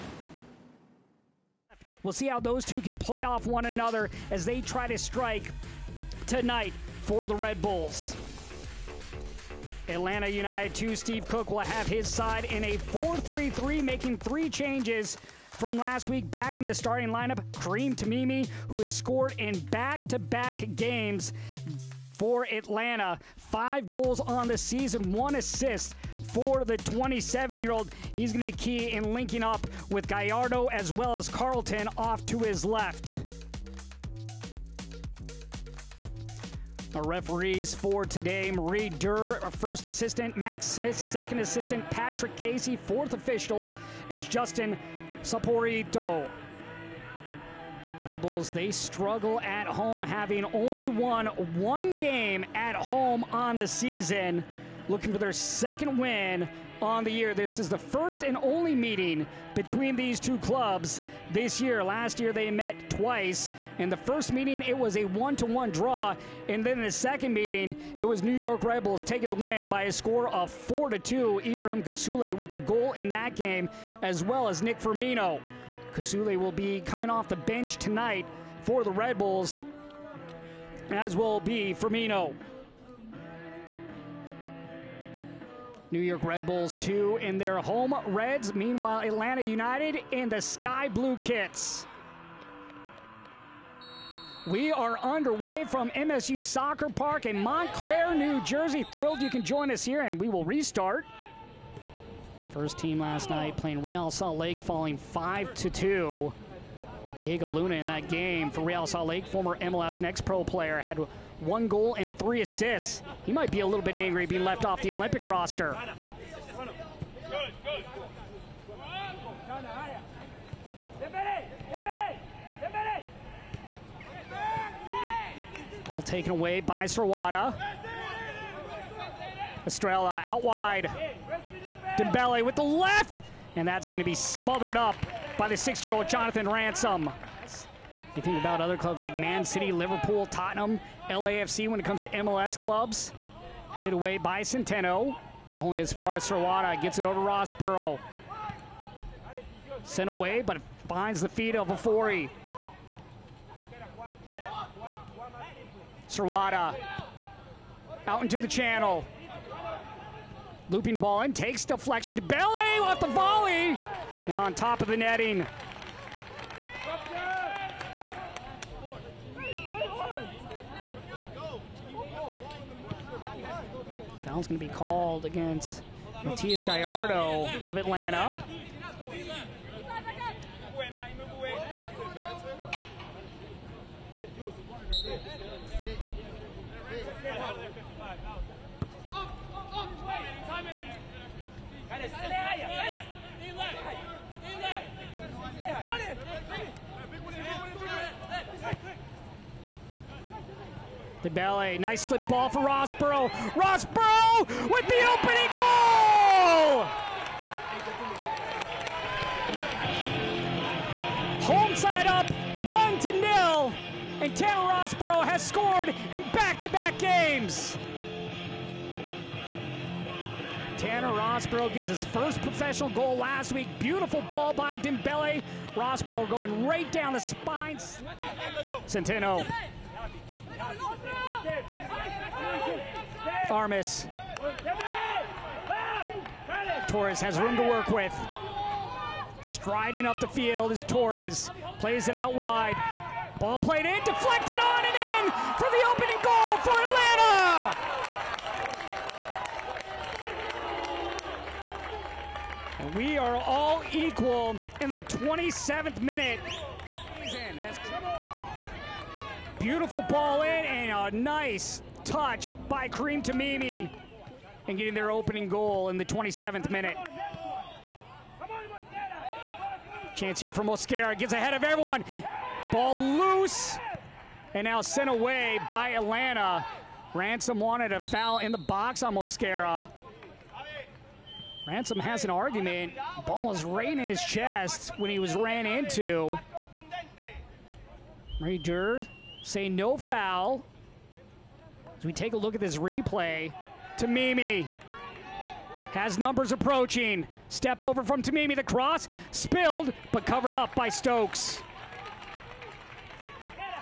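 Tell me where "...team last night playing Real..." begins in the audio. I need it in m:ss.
1:42.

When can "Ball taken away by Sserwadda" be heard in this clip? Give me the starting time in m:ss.
2:05.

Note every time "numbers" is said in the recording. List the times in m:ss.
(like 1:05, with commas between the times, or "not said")
4:56.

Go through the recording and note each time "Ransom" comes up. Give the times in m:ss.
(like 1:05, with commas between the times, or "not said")
2:16, 4:37, 4:41.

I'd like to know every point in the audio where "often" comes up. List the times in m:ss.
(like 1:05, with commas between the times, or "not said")
not said.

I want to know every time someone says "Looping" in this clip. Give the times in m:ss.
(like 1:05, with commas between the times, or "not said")
2:40.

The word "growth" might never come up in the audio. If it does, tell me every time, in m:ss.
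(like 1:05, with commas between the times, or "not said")
not said.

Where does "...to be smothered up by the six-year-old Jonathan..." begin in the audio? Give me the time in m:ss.
2:13.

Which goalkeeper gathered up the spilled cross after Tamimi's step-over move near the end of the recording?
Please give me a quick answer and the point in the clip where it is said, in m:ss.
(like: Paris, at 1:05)
Stokes, at 5:00.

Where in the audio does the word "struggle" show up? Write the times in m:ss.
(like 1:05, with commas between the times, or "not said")
0:48.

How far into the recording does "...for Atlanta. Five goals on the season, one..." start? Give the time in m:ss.
0:22.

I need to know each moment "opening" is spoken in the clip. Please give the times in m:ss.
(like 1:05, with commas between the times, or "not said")
3:25, 4:05, 4:25.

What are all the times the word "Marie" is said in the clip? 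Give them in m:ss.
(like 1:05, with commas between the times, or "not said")
0:38, 4:48.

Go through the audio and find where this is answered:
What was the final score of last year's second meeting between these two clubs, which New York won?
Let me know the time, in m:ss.
1:10.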